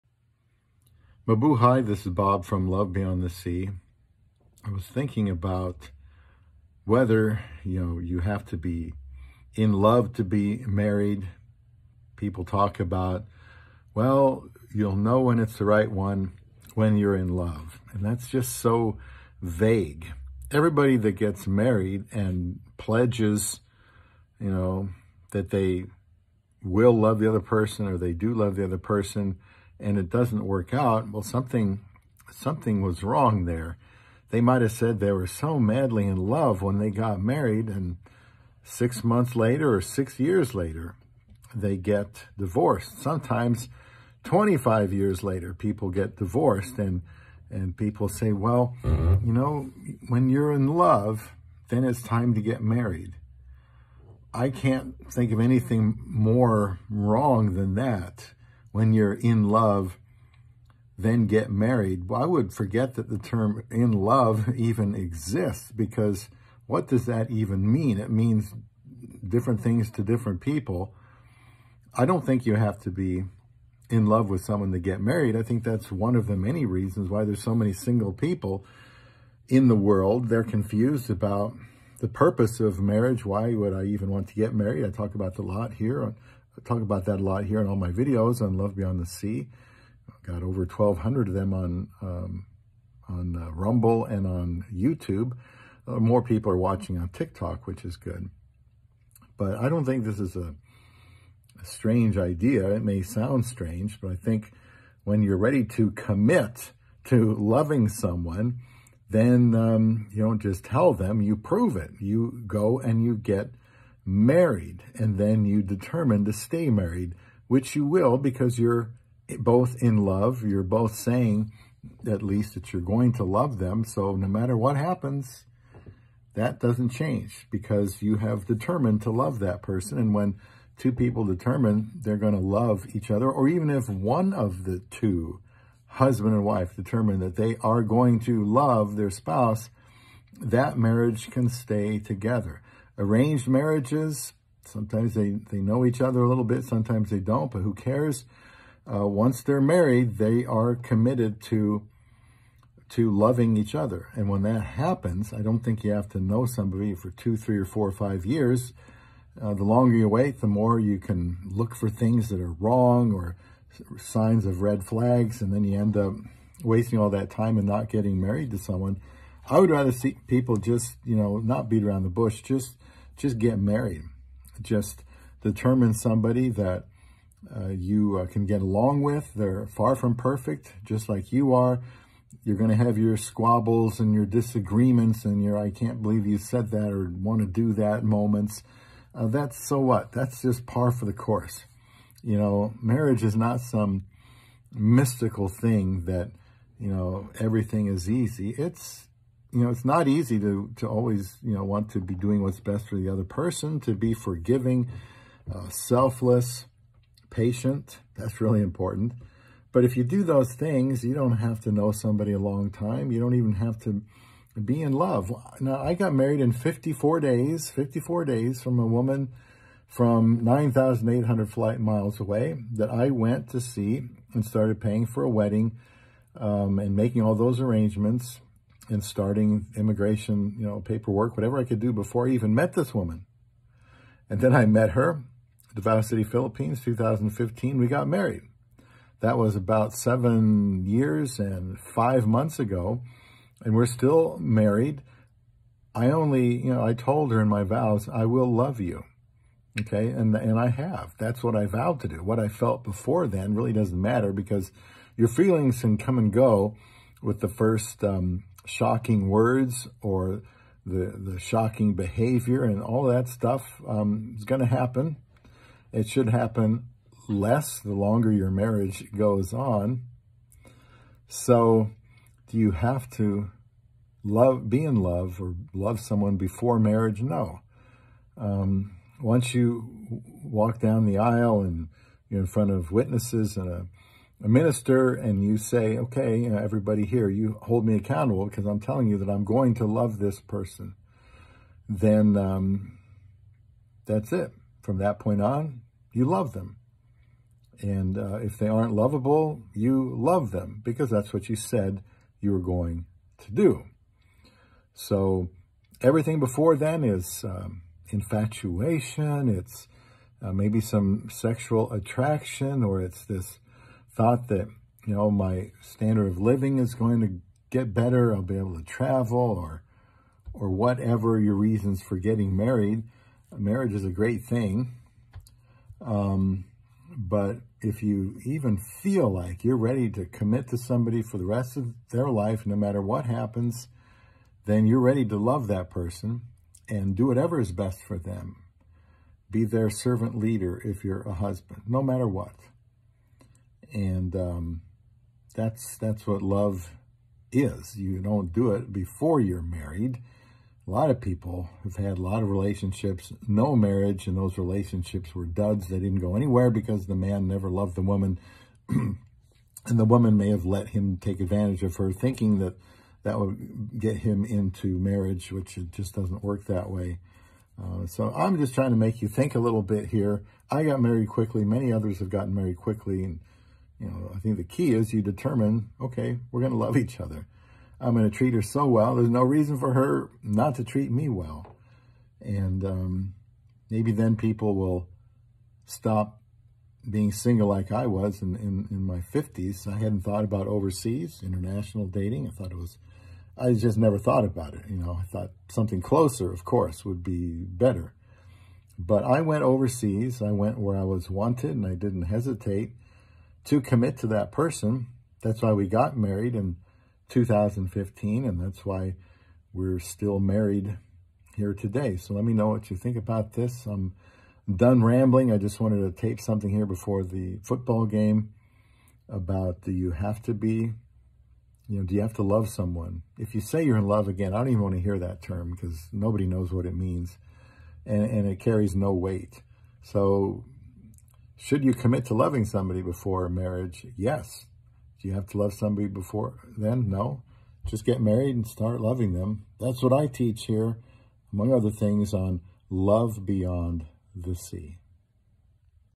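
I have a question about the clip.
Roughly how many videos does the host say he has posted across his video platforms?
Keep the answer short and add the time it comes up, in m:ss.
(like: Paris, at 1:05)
1,200, at 1:30.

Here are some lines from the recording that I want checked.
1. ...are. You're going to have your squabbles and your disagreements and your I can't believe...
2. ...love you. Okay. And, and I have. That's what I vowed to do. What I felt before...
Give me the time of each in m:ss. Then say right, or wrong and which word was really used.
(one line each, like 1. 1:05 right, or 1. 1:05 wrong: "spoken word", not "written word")
1. 3:01 right
2. 4:08 right.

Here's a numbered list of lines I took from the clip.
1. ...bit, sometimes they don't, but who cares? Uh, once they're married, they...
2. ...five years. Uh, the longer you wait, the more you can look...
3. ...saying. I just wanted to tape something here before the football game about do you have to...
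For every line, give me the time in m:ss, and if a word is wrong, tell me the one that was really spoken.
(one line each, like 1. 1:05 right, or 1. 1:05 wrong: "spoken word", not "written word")
1. 2:26 right
2. 2:37 right
3. 6:55 wrong: "rambling", not "saying".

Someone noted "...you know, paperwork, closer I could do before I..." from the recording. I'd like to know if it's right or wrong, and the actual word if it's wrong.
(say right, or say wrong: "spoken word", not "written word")
wrong: "whatever", not "closer".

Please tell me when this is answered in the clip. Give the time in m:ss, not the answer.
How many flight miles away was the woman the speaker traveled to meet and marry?
3:40.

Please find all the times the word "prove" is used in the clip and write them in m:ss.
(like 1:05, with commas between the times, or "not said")
1:51.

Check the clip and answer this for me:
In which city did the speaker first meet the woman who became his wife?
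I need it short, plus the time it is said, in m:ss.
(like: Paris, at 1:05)
Davao City, at 3:55.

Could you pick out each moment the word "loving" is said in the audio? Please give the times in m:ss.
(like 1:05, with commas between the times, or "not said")
1:47, 2:33, 7:12, 7:18.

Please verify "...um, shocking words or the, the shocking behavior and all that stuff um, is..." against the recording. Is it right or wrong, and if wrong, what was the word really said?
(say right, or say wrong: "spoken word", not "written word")
right.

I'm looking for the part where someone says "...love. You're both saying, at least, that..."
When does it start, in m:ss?
1:59.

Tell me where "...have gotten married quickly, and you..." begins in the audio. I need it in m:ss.
6:12.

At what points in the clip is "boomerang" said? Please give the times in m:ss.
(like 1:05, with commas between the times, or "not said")
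not said.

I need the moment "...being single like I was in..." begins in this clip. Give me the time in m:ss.
6:27.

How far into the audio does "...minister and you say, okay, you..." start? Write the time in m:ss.
4:44.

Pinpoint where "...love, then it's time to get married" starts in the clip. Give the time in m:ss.
0:50.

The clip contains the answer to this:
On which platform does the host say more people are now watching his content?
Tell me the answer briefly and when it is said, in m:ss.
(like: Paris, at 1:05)
TikTok, at 1:37.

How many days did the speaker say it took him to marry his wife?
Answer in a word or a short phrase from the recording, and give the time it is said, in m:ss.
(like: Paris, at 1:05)
54, at 3:36.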